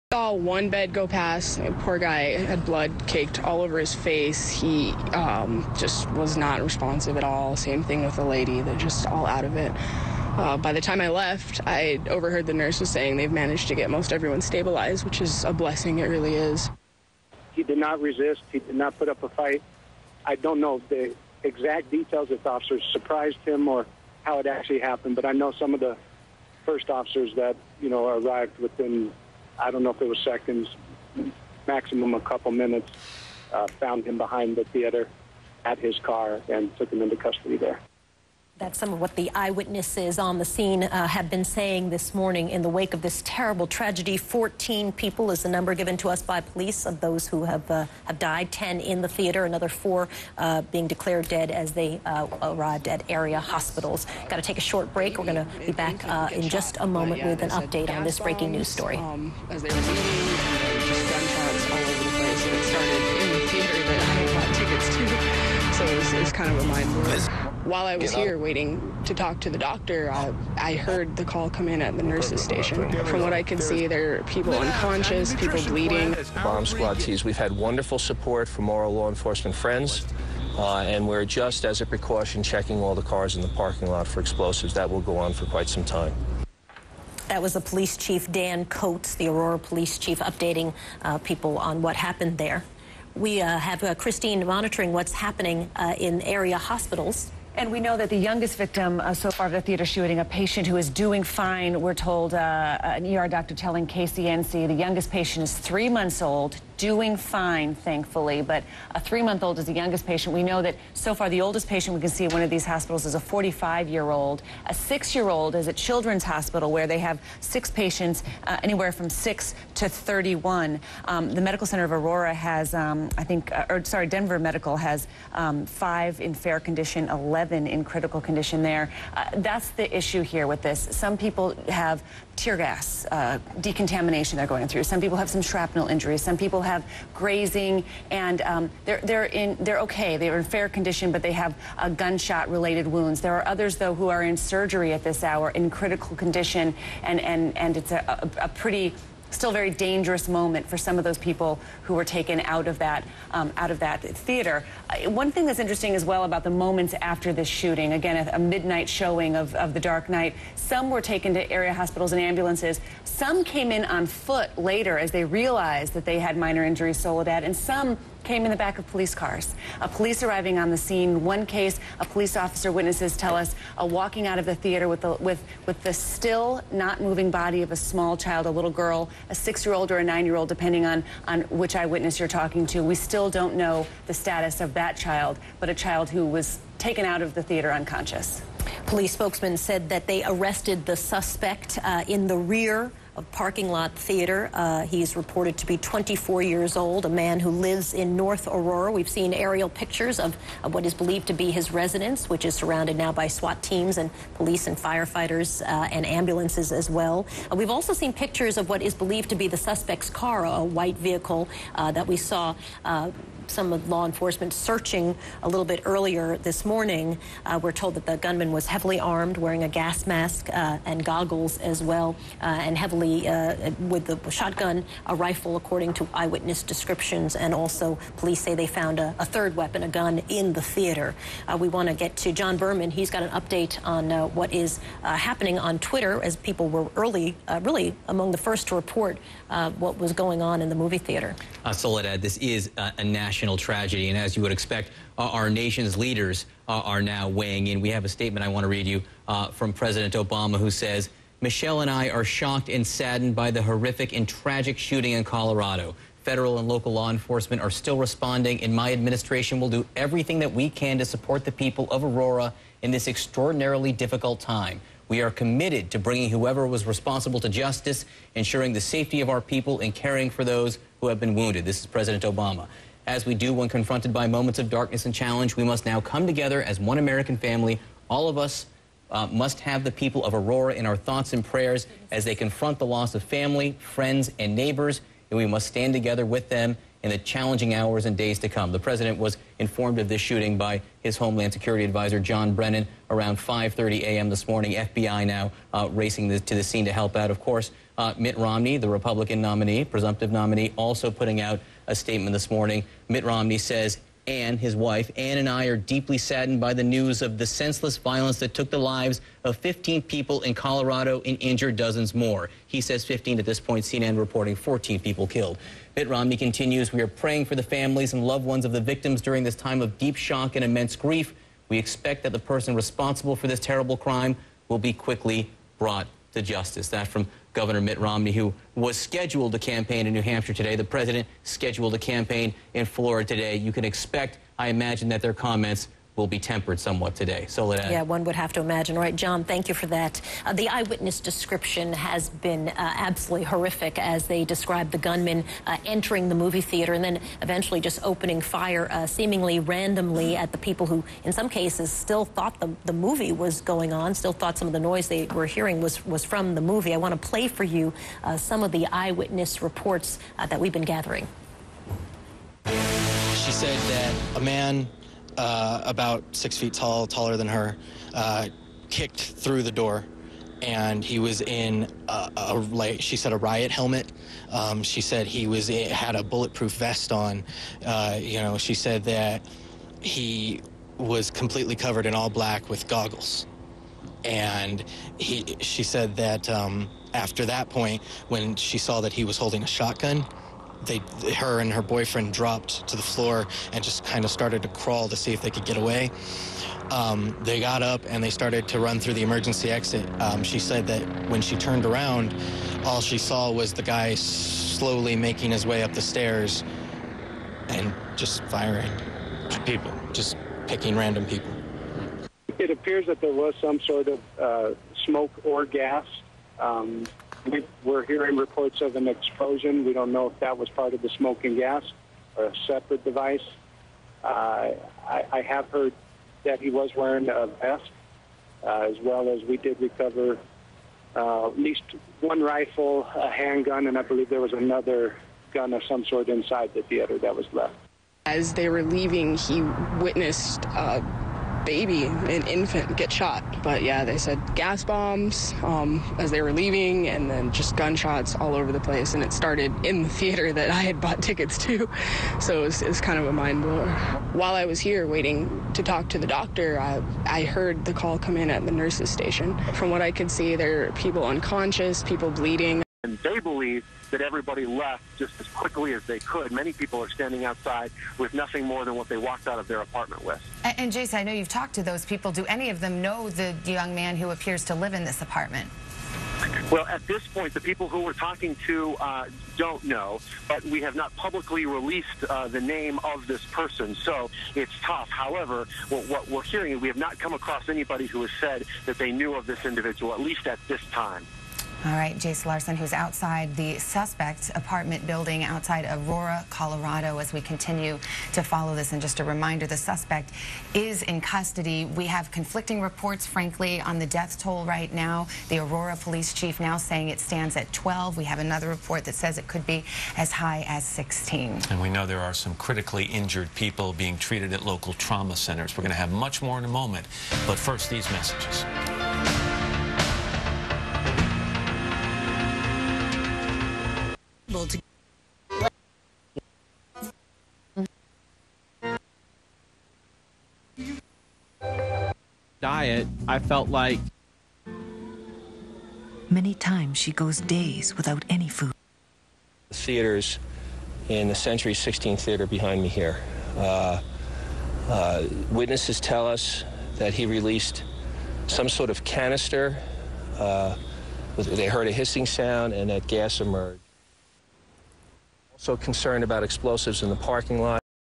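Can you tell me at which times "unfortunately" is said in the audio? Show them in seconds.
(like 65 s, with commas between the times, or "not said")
not said.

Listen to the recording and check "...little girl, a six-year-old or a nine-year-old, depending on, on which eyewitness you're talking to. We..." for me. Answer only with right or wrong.
right.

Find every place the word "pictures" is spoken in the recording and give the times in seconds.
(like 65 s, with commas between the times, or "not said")
199 s, 208 s.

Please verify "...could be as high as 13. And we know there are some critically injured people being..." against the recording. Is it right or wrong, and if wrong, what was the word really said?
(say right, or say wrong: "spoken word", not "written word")
wrong: "16", not "13".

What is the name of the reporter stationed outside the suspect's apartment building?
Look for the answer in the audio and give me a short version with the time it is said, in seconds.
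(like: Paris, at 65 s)
Jace Larson, at 492 s.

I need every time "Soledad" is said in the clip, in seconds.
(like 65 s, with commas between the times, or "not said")
166 s, 241 s, 337 s.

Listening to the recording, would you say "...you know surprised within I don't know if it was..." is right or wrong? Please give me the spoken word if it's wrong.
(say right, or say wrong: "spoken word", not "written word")
wrong: "arrived", not "surprised".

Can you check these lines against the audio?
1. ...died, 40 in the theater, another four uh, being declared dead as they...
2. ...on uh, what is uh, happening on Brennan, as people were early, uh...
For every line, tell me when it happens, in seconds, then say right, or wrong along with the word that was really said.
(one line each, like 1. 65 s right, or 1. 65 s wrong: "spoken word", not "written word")
1. 48 s wrong: "10", not "40"
2. 233 s wrong: "Twitter", not "Brennan".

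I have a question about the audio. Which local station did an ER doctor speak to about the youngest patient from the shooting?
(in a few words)
KCNC.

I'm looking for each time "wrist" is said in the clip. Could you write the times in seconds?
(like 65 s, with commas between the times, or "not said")
not said.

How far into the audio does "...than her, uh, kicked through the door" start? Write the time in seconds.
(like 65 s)
367 s.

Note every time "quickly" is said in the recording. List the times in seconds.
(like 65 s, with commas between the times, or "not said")
324 s, 465 s.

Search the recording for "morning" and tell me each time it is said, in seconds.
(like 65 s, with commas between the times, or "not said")
42 s, 216 s, 294 s, 302 s.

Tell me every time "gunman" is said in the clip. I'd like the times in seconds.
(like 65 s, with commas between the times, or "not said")
218 s, 344 s.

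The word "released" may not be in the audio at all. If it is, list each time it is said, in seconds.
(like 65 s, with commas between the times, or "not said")
481 s, 547 s.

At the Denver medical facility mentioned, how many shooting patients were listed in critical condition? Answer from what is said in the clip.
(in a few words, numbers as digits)
11.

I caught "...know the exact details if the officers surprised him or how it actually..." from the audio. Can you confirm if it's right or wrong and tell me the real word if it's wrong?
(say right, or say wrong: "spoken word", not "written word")
right.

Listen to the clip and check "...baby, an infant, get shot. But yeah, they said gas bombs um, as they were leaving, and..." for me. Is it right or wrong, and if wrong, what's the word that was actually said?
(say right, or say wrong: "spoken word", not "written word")
right.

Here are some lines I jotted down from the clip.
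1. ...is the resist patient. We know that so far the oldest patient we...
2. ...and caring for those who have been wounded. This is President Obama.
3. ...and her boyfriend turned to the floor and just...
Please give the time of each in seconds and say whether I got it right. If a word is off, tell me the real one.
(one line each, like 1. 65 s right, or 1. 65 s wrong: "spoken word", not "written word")
1. 109 s wrong: "youngest", not "resist"
2. 269 s right
3. 391 s wrong: "dropped", not "turned".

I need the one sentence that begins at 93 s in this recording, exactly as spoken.
We uh, have uh, Christine monitoring what's happening uh, in area hospitals.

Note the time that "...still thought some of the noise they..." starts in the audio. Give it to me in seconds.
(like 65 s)
354 s.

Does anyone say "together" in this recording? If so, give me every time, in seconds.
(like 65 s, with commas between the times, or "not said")
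276 s, 285 s.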